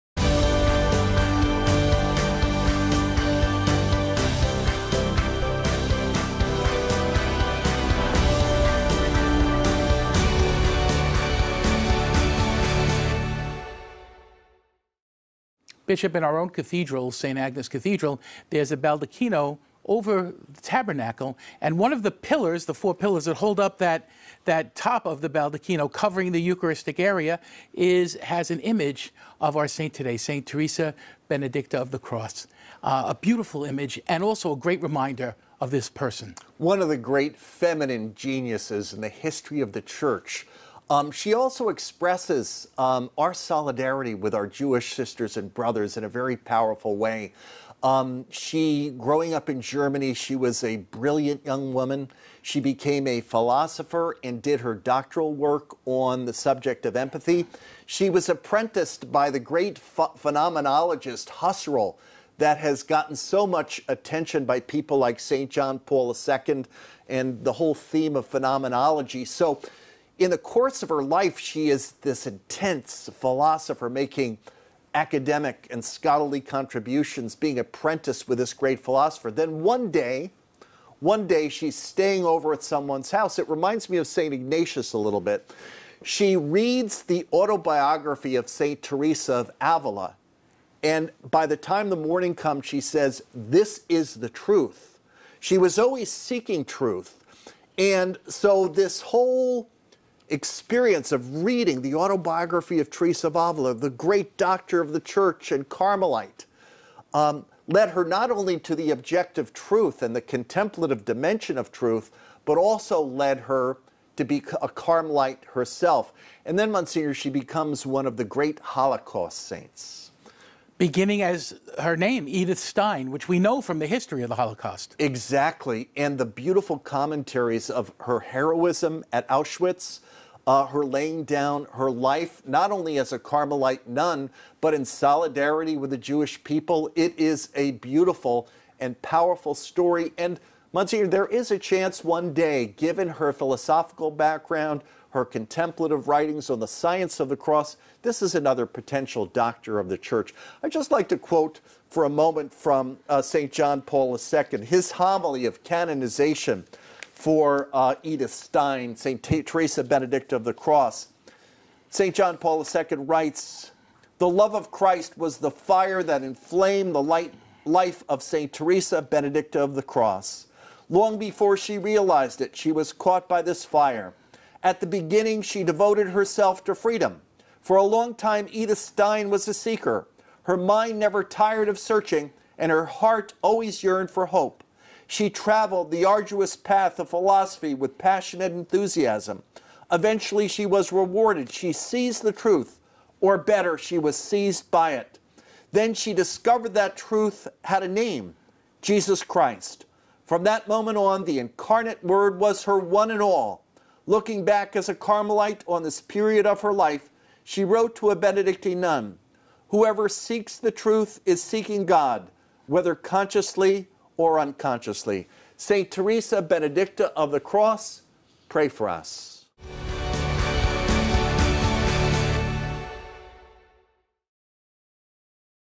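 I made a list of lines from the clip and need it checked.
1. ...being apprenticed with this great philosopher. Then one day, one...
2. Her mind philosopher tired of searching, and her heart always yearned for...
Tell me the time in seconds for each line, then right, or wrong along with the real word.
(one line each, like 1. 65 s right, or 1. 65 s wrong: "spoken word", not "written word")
1. 77 s right
2. 180 s wrong: "never", not "philosopher".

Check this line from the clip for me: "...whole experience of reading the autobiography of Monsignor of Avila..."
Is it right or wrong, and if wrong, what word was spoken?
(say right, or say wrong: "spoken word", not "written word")
wrong: "Teresa", not "Monsignor".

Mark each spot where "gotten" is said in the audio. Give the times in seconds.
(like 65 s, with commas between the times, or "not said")
62 s.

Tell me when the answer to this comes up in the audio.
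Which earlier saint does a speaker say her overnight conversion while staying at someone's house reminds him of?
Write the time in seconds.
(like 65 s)
84 s.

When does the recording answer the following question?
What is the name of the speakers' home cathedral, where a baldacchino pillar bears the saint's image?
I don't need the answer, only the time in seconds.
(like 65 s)
17 s.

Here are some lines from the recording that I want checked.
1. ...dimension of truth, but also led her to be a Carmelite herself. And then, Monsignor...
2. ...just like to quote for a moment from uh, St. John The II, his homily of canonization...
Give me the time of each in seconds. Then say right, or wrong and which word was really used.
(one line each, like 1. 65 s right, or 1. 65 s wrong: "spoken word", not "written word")
1. 111 s right
2. 150 s wrong: "Paul", not "The".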